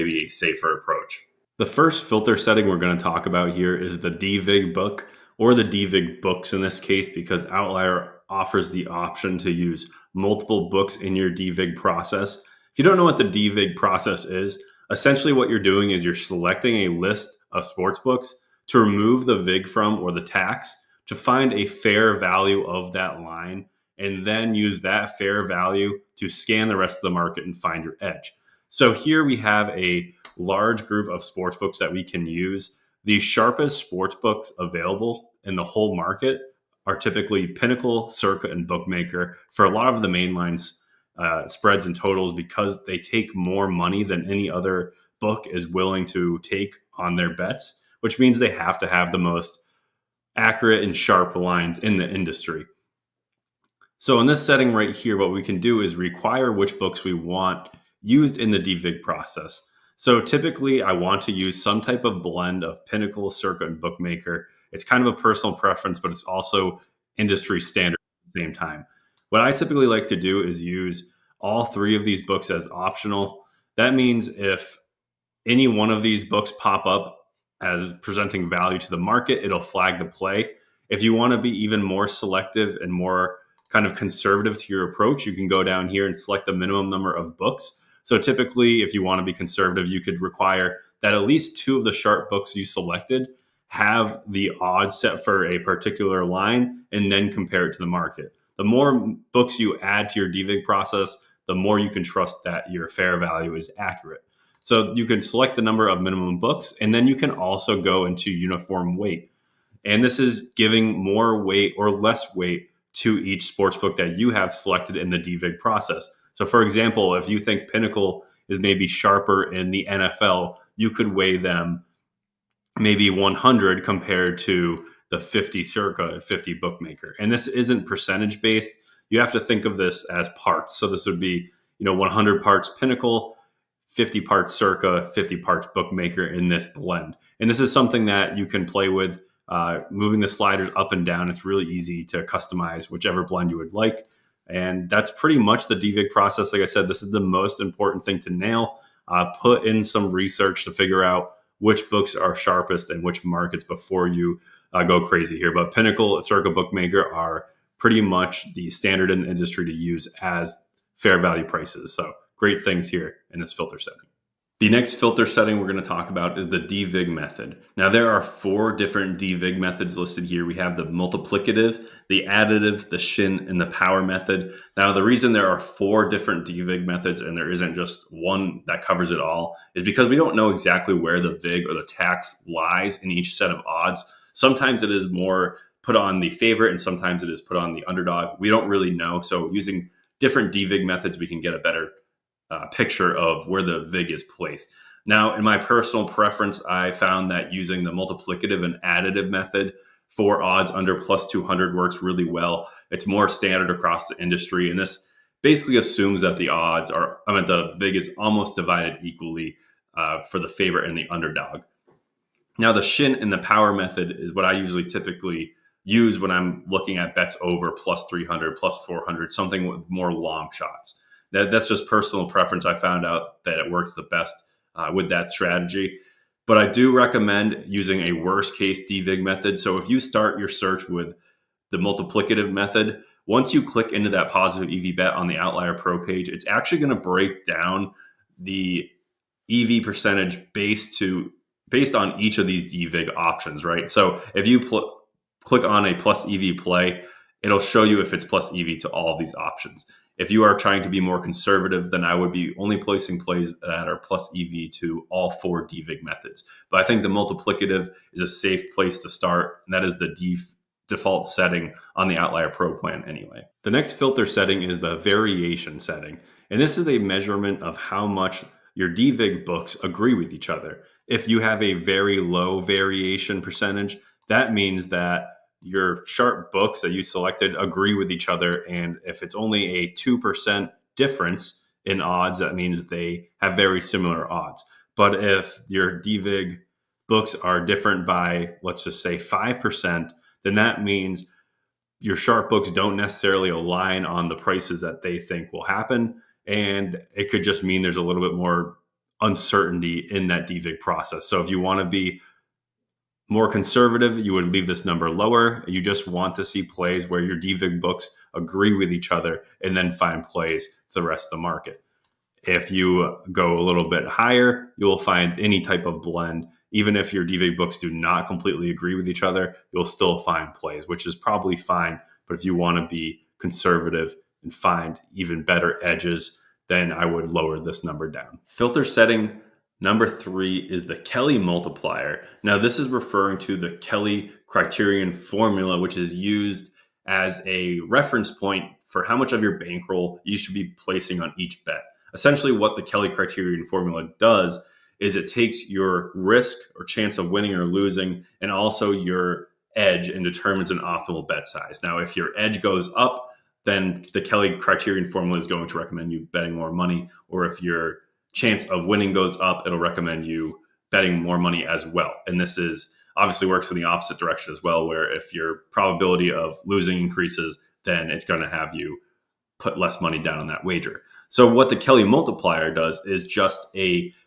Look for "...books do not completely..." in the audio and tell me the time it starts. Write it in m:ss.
5:17.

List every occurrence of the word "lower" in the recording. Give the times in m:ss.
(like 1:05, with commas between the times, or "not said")
5:05, 5:27.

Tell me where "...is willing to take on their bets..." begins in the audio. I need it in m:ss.
0:45.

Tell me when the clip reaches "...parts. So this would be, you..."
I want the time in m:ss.
2:10.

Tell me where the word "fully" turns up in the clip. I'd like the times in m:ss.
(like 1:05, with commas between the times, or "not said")
not said.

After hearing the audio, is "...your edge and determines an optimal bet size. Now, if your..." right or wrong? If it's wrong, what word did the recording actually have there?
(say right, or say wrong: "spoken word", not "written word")
right.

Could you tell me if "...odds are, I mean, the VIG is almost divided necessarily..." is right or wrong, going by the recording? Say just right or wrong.
wrong.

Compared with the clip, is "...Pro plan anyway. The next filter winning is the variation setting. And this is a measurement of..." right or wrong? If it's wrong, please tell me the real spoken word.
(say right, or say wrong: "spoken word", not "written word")
wrong: "setting", not "winning".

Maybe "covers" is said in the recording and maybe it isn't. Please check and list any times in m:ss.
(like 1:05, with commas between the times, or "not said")
2:58.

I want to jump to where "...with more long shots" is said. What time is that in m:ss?
3:39.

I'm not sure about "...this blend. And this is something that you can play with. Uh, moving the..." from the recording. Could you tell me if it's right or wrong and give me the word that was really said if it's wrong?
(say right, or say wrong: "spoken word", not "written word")
right.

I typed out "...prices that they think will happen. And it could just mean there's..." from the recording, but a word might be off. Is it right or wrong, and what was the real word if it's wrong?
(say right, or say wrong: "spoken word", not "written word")
right.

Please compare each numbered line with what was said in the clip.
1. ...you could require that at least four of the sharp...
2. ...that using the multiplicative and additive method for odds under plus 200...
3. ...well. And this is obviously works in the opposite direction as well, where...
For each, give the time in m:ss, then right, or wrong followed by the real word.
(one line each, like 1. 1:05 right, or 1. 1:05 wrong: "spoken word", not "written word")
1. 1:29 wrong: "two", not "four"
2. 3:17 right
3. 6:01 right.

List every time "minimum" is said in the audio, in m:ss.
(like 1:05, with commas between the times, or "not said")
1:26, 1:46.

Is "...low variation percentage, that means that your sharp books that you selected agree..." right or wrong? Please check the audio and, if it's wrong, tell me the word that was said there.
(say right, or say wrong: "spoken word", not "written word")
right.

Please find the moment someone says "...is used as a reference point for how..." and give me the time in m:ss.
5:35.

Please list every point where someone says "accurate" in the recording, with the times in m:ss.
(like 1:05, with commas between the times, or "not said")
0:50, 1:43.